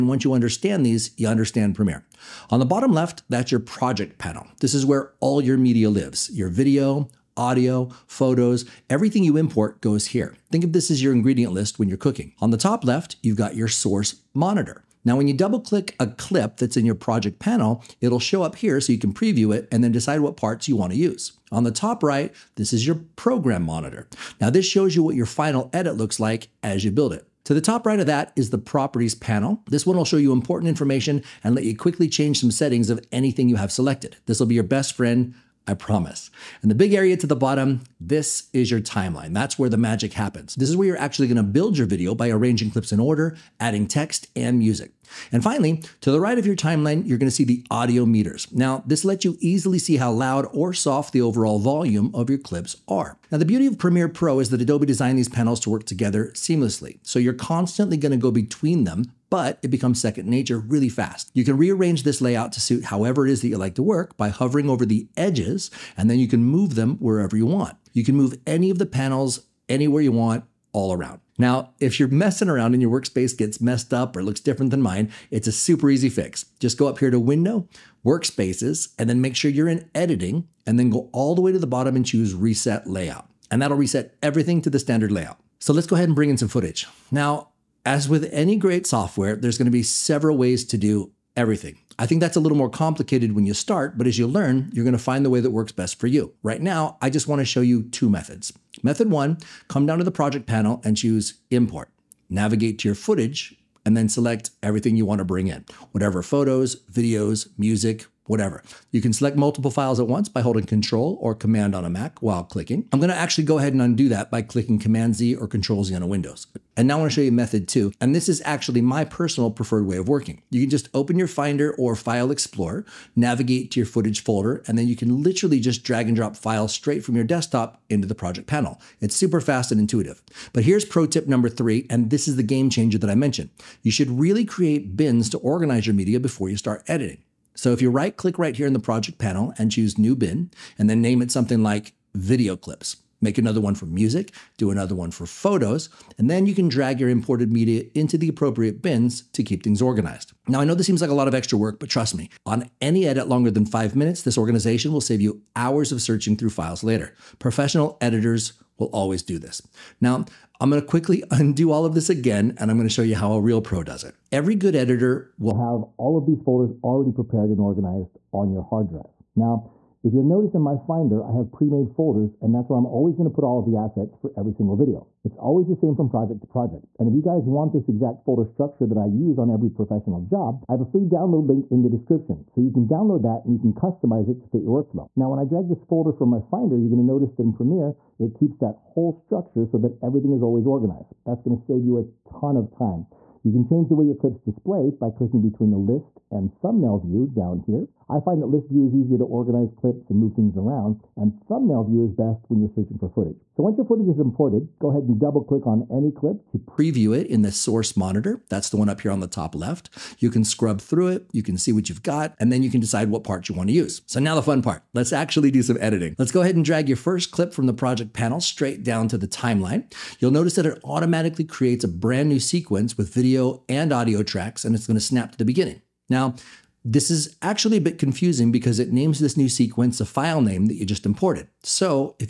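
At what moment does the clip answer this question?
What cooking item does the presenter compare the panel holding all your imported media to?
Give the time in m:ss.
0:11.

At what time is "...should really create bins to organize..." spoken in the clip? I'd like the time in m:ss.
2:13.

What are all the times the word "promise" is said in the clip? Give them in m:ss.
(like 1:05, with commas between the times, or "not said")
0:35.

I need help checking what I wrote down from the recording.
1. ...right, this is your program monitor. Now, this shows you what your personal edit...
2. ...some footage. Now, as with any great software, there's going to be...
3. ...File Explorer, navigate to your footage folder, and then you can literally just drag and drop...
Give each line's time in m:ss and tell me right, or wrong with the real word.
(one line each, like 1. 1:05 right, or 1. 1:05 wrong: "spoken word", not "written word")
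1. 0:22 wrong: "final", not "personal"
2. 1:26 right
3. 2:01 right.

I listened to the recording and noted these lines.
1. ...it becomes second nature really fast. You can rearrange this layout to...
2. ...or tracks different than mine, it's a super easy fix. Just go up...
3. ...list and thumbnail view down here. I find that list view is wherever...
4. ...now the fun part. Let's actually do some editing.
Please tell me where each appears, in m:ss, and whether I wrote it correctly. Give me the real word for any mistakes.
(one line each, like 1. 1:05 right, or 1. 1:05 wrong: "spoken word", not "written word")
1. 0:59 right
2. 1:14 wrong: "looks", not "tracks"
3. 3:15 wrong: "easier", not "wherever"
4. 3:34 right.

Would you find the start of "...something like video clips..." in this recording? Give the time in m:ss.
2:21.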